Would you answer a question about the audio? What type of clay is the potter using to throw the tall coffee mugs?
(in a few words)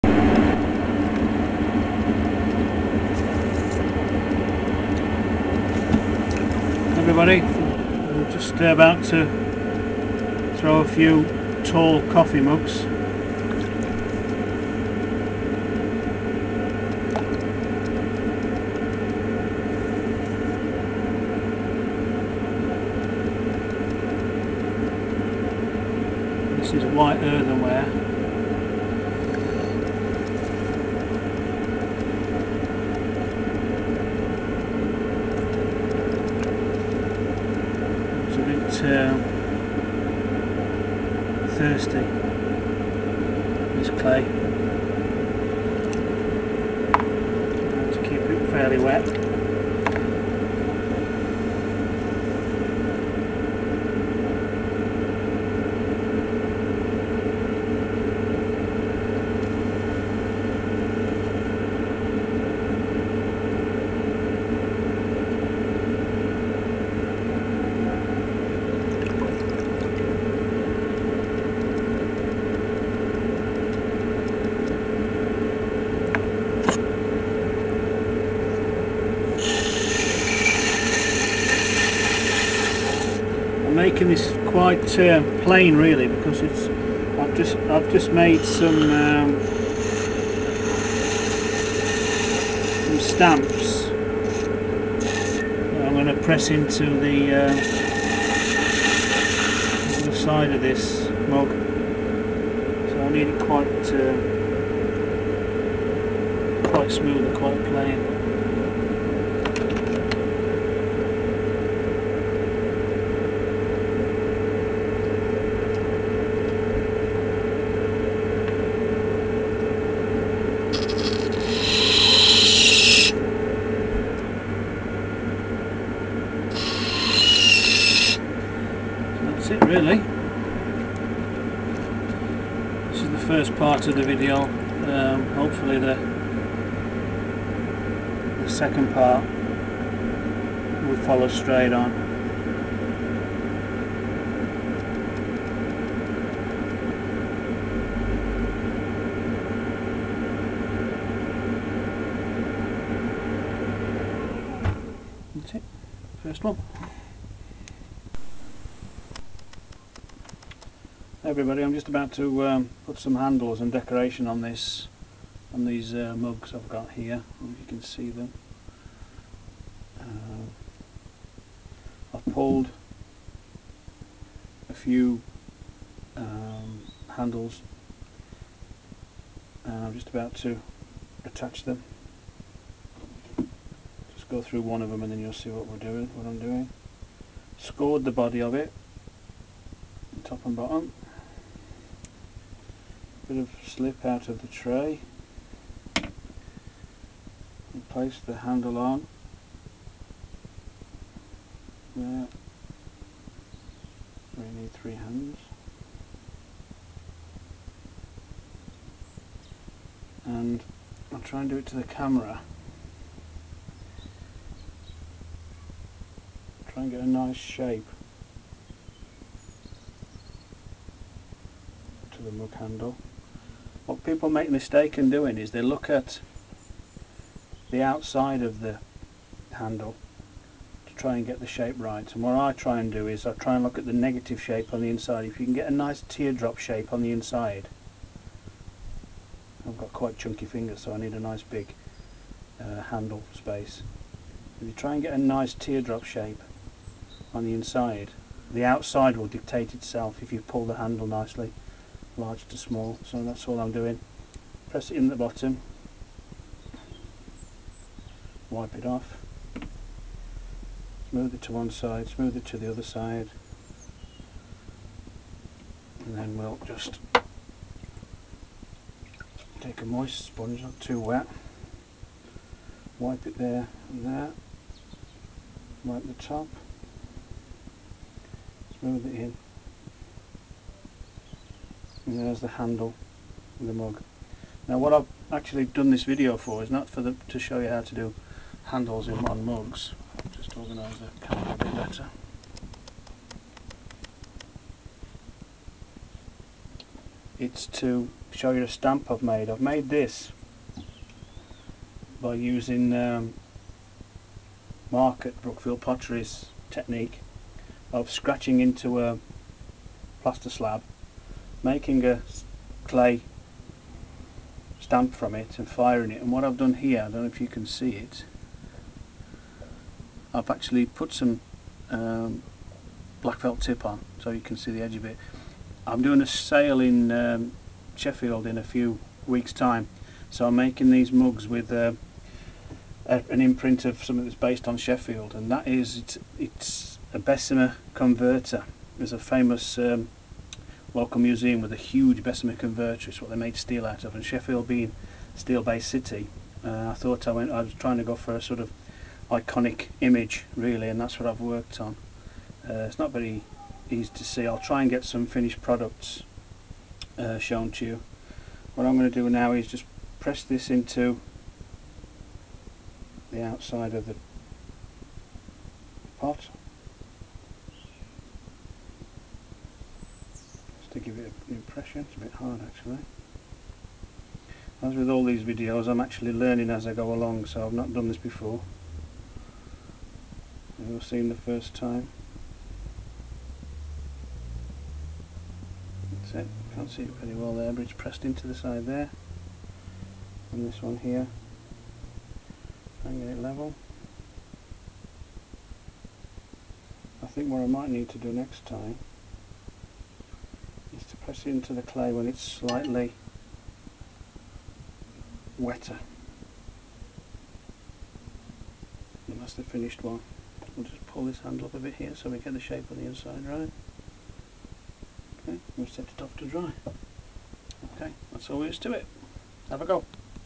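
White earthenware.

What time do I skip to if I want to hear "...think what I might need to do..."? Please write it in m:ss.
6:37.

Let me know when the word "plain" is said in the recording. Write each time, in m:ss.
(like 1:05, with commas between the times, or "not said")
1:25, 1:47.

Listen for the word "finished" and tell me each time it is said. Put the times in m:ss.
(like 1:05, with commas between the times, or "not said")
5:55, 6:49.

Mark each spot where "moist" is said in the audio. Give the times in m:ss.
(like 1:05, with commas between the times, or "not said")
4:29.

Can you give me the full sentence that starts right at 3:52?
And what I try and do is I try and look at the negative shape on the inside.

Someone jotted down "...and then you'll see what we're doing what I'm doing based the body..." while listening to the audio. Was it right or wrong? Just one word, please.
wrong.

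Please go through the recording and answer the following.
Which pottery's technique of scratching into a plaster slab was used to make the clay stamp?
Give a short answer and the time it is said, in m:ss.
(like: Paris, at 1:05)
Brookfield Pottery, at 5:05.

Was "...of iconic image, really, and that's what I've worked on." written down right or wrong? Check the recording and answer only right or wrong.
right.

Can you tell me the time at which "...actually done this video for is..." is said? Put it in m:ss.
4:45.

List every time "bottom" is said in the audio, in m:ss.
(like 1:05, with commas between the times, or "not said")
3:10, 4:15.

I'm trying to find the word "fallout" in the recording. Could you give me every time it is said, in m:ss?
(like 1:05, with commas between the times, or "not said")
not said.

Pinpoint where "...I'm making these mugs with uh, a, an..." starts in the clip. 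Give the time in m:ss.
5:30.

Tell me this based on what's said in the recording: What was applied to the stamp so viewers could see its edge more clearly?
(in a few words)
Black felt tip.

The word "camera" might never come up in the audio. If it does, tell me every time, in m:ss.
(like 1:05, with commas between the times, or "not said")
3:31, 4:51.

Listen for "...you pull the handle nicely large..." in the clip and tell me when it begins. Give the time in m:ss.
4:10.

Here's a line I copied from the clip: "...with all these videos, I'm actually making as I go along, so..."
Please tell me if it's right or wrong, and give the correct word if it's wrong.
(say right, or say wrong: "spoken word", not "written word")
wrong: "learning", not "making".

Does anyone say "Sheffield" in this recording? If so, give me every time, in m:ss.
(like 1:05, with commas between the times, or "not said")
5:27, 5:34, 5:44.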